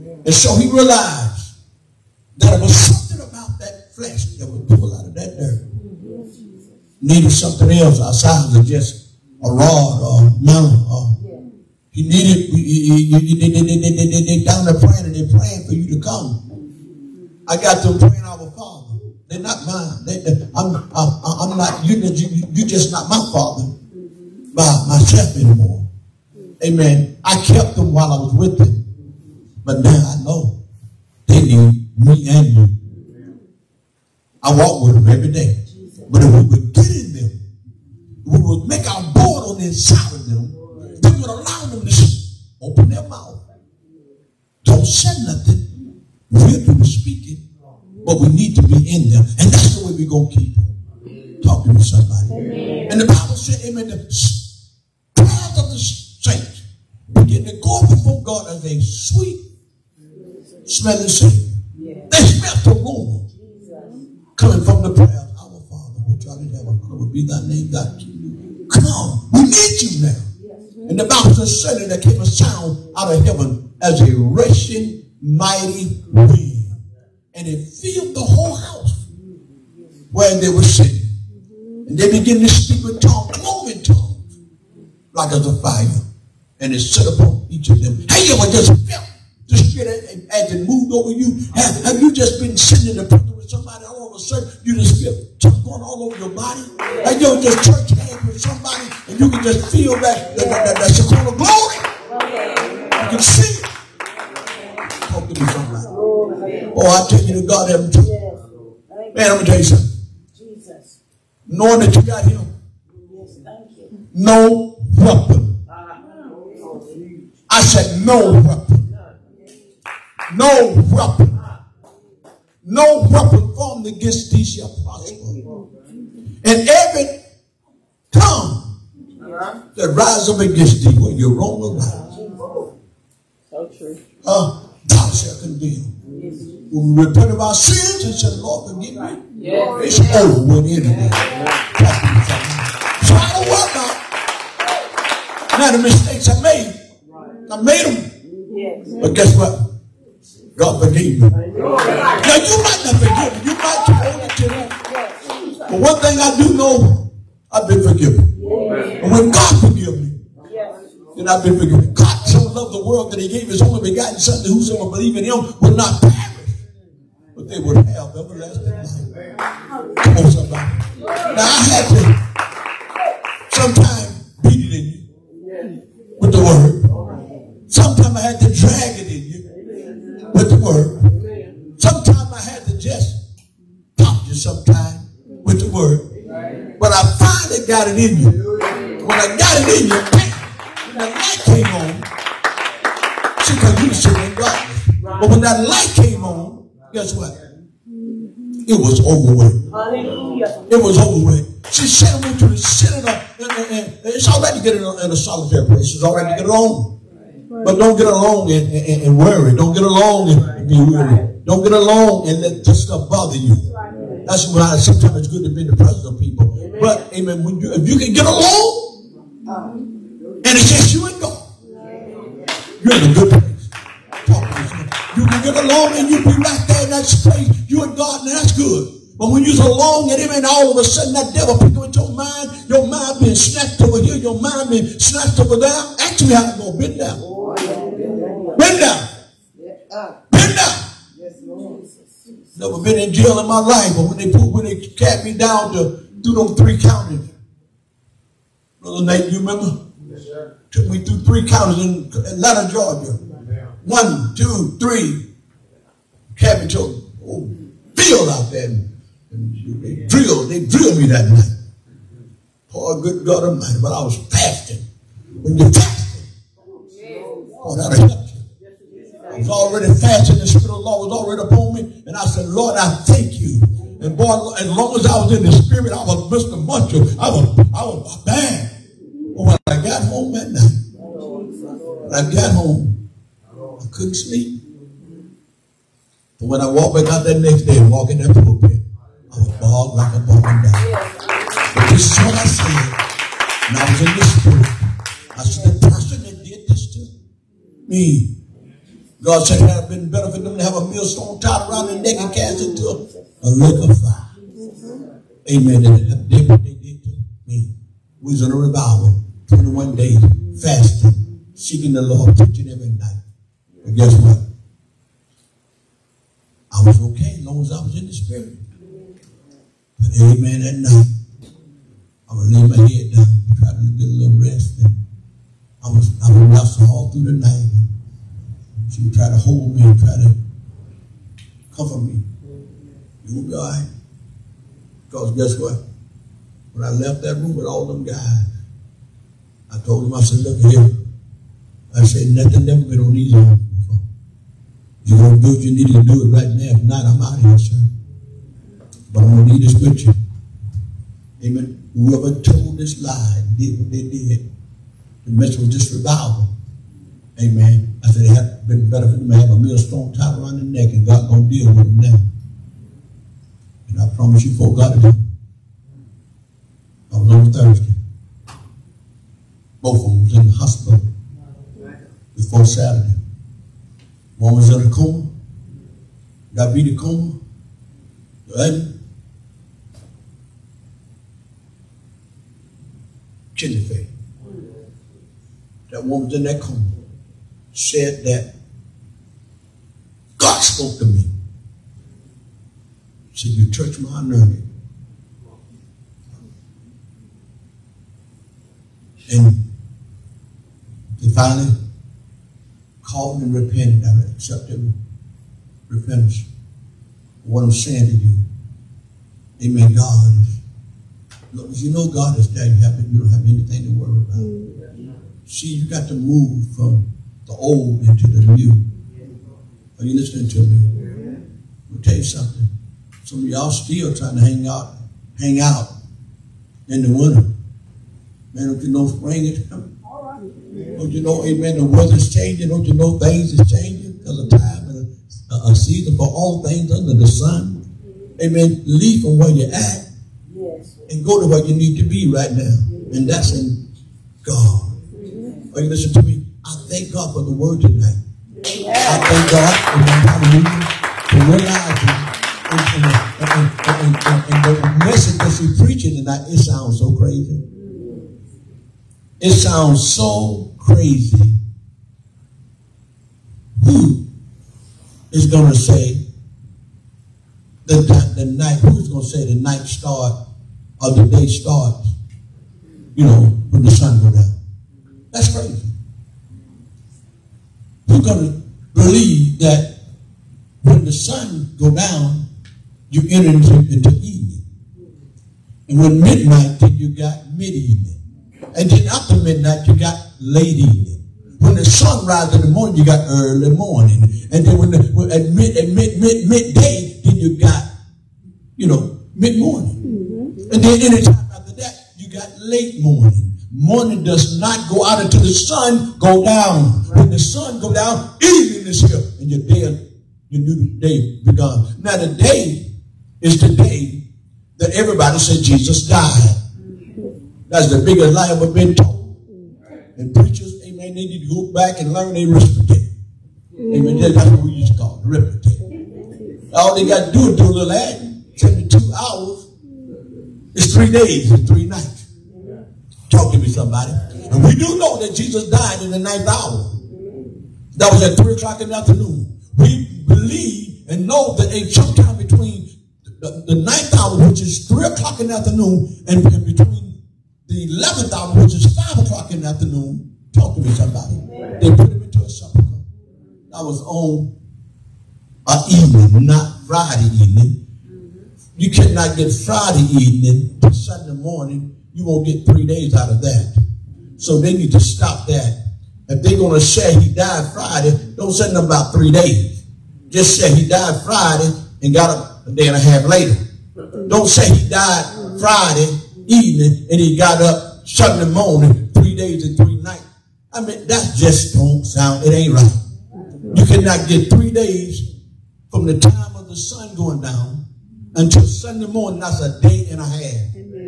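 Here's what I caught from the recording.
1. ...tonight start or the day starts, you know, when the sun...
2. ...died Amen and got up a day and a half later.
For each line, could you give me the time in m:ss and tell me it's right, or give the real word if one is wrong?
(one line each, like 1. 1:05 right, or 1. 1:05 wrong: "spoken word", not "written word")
1. 7:49 wrong: "night", not "tonight"
2. 9:30 wrong: "Friday", not "Amen".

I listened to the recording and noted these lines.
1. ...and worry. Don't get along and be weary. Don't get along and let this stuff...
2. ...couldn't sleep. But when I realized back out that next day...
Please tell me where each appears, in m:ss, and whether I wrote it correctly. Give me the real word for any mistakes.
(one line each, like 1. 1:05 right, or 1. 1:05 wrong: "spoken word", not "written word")
1. 3:29 right
2. 4:43 wrong: "walked", not "realized".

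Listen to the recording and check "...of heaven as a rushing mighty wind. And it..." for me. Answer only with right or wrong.
right.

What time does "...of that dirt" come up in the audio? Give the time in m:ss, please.
0:05.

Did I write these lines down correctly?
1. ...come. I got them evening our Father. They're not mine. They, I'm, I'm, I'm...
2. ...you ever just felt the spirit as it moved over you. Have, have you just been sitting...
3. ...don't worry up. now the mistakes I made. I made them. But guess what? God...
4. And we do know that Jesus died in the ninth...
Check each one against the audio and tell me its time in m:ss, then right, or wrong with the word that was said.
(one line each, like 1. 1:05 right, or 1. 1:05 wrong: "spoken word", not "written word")
1. 0:15 wrong: "praying", not "evening"
2. 1:28 right
3. 2:25 right
4. 8:54 right.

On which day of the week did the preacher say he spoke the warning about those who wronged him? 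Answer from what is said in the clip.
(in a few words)
Thursday.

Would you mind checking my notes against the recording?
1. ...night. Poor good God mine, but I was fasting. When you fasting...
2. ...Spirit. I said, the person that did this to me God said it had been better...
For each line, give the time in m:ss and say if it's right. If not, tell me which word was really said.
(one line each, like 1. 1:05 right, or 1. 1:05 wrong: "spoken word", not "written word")
1. 4:21 right
2. 4:54 right.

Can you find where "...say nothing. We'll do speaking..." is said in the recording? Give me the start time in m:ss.
0:44.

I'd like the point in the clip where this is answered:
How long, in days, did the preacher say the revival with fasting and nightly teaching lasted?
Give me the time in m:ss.
5:09.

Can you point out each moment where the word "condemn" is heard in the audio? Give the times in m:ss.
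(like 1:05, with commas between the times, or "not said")
2:15.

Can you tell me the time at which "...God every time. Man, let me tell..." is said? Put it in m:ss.
1:47.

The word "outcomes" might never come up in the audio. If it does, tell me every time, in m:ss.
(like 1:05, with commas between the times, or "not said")
not said.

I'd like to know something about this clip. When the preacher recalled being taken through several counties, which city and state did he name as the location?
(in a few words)
Atlanta, Georgia.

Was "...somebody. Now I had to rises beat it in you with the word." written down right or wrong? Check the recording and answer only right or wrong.
wrong.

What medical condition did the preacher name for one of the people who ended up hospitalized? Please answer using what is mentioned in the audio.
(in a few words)
Kidney failure.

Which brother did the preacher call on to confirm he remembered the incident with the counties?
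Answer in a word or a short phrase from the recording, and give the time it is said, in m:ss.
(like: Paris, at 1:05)
Brother Nate, at 4:08.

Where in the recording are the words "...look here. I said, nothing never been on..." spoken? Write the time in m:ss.
5:40.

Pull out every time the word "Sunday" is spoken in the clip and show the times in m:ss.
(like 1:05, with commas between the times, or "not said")
9:20, 9:38, 9:48.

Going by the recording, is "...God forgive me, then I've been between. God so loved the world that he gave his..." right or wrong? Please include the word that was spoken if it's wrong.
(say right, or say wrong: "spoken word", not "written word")
wrong: "forgiven", not "between".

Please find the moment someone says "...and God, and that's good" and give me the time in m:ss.
3:47.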